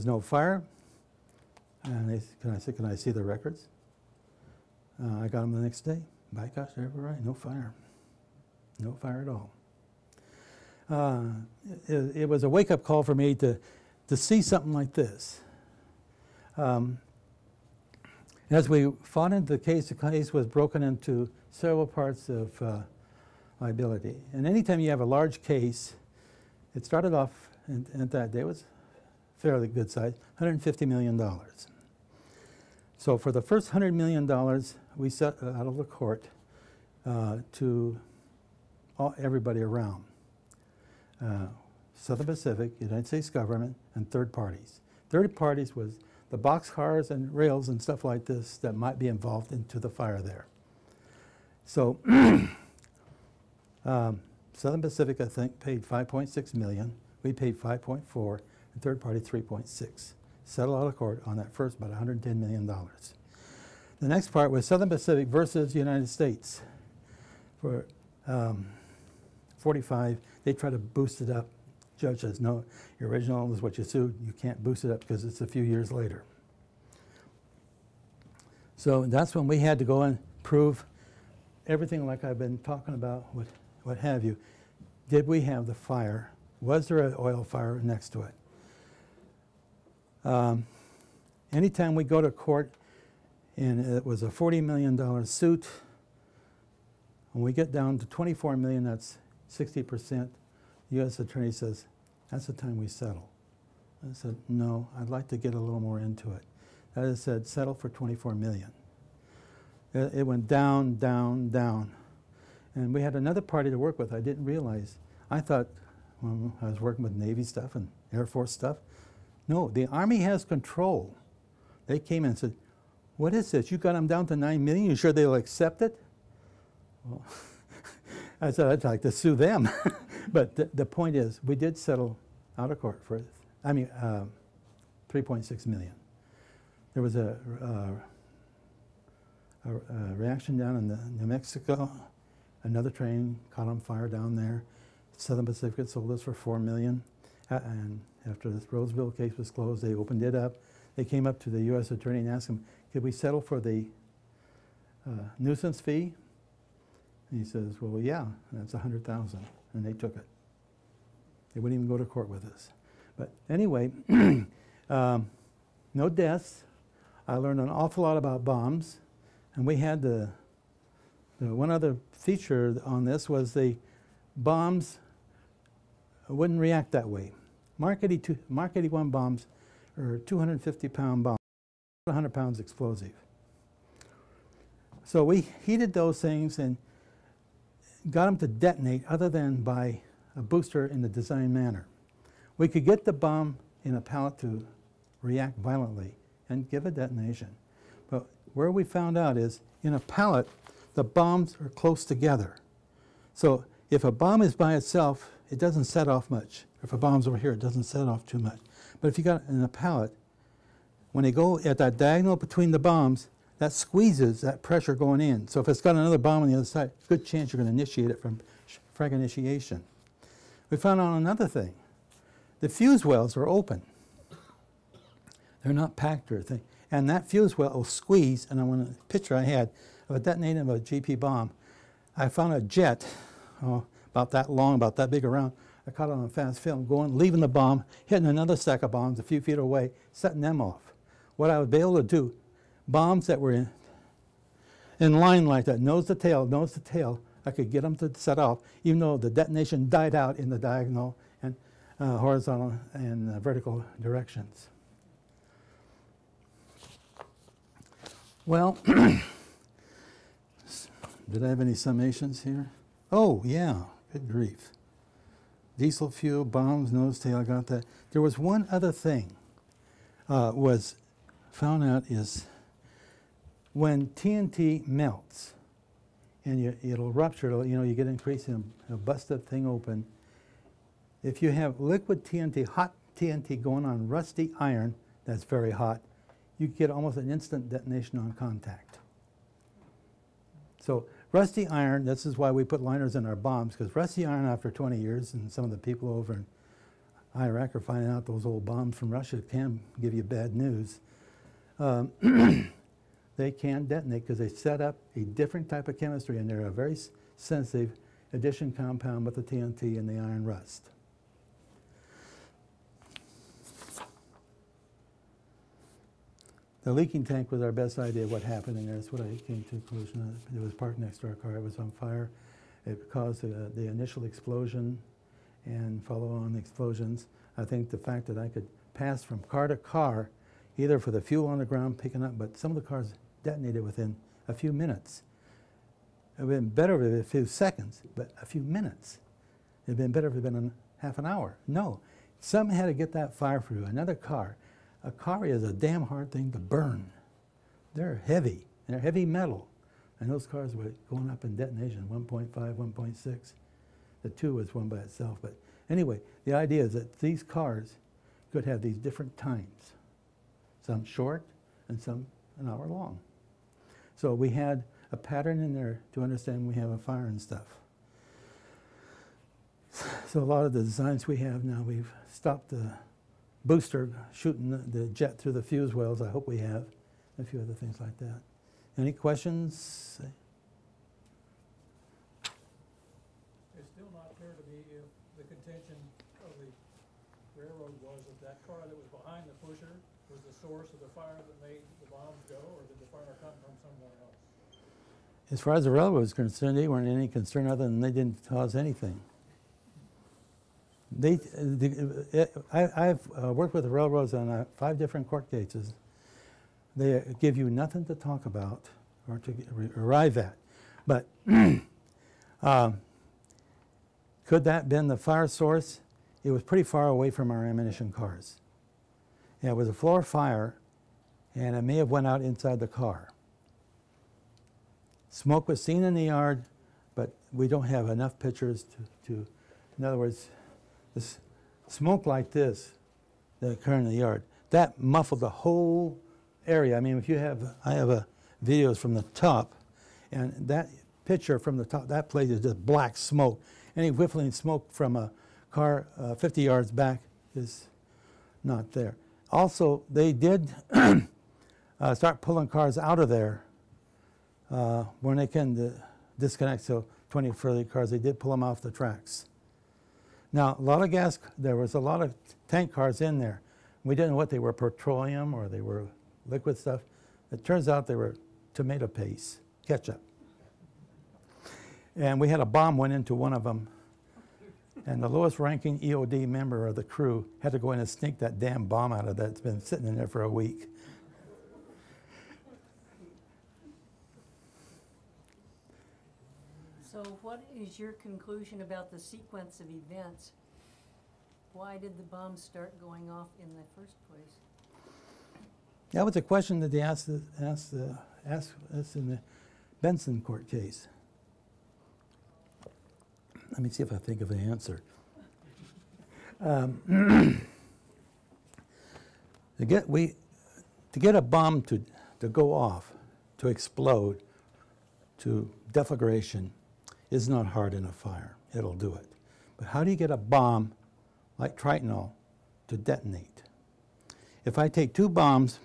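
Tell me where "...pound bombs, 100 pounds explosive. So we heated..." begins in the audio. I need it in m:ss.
3:00.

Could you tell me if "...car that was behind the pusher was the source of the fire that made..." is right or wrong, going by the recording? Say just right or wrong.
right.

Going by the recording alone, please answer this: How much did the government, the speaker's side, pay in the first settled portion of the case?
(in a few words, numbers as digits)
$5.4 million.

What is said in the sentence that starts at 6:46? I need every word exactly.
They give you nothing to talk about or to arrive at.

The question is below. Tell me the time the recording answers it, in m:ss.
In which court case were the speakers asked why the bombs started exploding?
8:19.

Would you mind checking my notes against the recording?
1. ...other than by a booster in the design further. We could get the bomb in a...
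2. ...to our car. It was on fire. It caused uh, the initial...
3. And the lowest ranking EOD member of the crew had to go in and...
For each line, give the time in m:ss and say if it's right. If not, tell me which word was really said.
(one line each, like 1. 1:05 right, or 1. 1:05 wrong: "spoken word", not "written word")
1. 3:09 wrong: "manner", not "further"
2. 5:21 right
3. 7:55 right.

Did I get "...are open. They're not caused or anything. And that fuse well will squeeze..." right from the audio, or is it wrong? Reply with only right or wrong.
wrong.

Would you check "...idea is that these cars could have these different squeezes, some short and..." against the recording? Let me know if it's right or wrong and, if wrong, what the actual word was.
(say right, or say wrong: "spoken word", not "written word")
wrong: "times", not "squeezes".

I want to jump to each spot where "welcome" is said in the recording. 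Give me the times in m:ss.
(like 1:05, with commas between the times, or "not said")
not said.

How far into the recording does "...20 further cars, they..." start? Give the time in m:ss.
7:37.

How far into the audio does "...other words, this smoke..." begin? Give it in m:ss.
7:10.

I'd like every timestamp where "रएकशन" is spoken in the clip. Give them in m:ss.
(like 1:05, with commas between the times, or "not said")
not said.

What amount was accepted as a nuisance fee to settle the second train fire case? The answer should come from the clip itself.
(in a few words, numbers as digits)
100,000.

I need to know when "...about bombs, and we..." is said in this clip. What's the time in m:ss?
2:48.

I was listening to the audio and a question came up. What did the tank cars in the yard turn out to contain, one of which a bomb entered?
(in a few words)
tomato paste, ketchup.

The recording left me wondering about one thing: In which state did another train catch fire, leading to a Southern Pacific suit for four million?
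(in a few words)
New Mexico.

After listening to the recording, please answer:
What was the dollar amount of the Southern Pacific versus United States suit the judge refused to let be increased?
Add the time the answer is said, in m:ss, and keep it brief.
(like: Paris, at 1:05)
45 million, at 1:09.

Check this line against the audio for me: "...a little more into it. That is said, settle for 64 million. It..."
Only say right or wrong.
wrong.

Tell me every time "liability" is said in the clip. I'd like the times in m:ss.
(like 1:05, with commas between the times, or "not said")
0:23.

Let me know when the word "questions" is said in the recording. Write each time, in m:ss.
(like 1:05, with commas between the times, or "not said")
6:19, 8:16.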